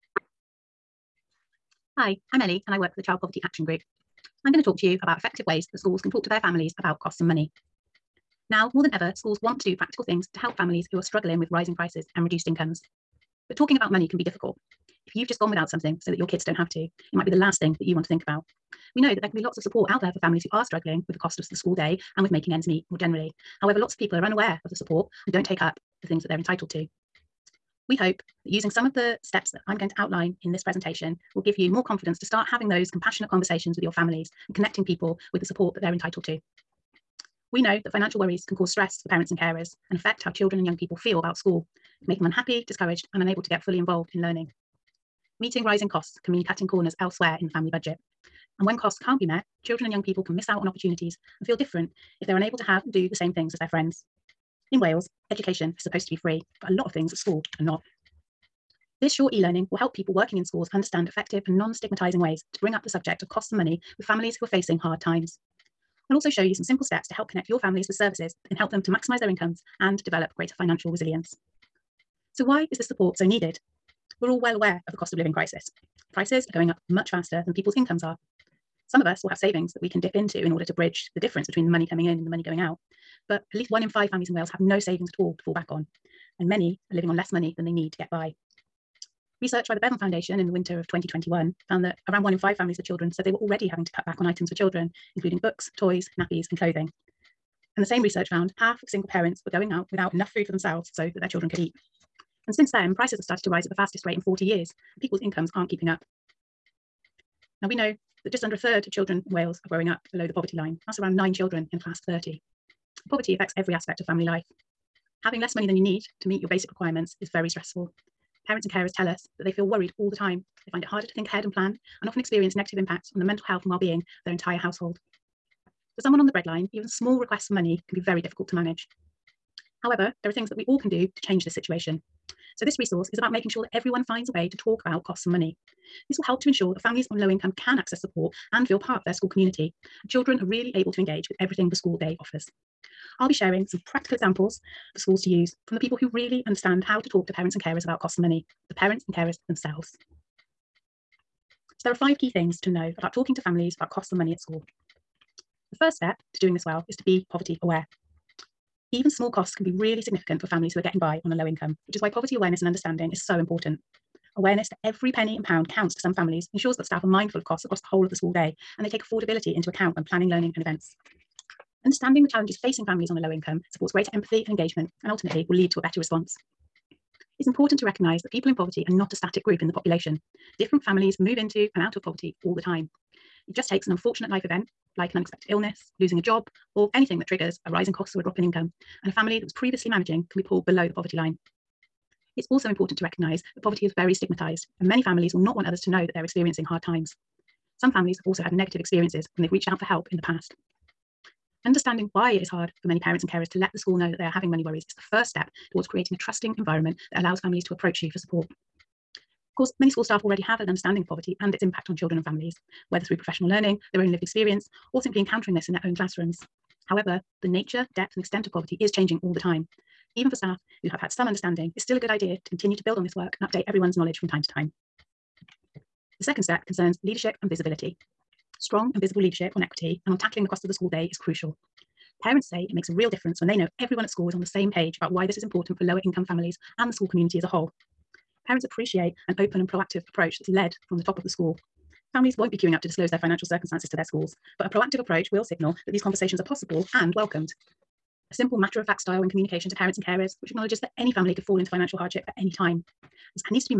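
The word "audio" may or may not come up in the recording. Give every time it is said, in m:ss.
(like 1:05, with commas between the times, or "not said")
not said.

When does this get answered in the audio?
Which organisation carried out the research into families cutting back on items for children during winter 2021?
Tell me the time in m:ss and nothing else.
1:29.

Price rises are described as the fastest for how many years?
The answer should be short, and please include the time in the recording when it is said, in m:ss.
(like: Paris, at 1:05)
40 years, at 1:44.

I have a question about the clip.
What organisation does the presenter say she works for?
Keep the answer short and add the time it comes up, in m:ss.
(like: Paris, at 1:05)
Child Poverty Action Group, at 0:03.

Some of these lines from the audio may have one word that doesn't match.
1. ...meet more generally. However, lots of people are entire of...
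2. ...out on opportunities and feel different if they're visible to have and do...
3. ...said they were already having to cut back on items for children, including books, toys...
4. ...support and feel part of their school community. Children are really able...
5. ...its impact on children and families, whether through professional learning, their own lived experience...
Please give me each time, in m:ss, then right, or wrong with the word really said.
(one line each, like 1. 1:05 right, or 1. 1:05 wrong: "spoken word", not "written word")
1. 0:22 wrong: "unaware", not "entire"
2. 0:50 wrong: "unable", not "visible"
3. 1:33 right
4. 2:18 right
5. 3:31 right.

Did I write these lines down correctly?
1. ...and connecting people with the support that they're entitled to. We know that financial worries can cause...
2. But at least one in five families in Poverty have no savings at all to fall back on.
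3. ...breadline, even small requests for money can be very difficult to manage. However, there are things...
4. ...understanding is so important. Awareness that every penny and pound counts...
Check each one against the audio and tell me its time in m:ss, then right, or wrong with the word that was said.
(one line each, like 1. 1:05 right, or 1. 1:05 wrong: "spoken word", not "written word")
1. 0:34 right
2. 1:23 wrong: "Wales", not "Poverty"
3. 2:06 right
4. 2:42 right.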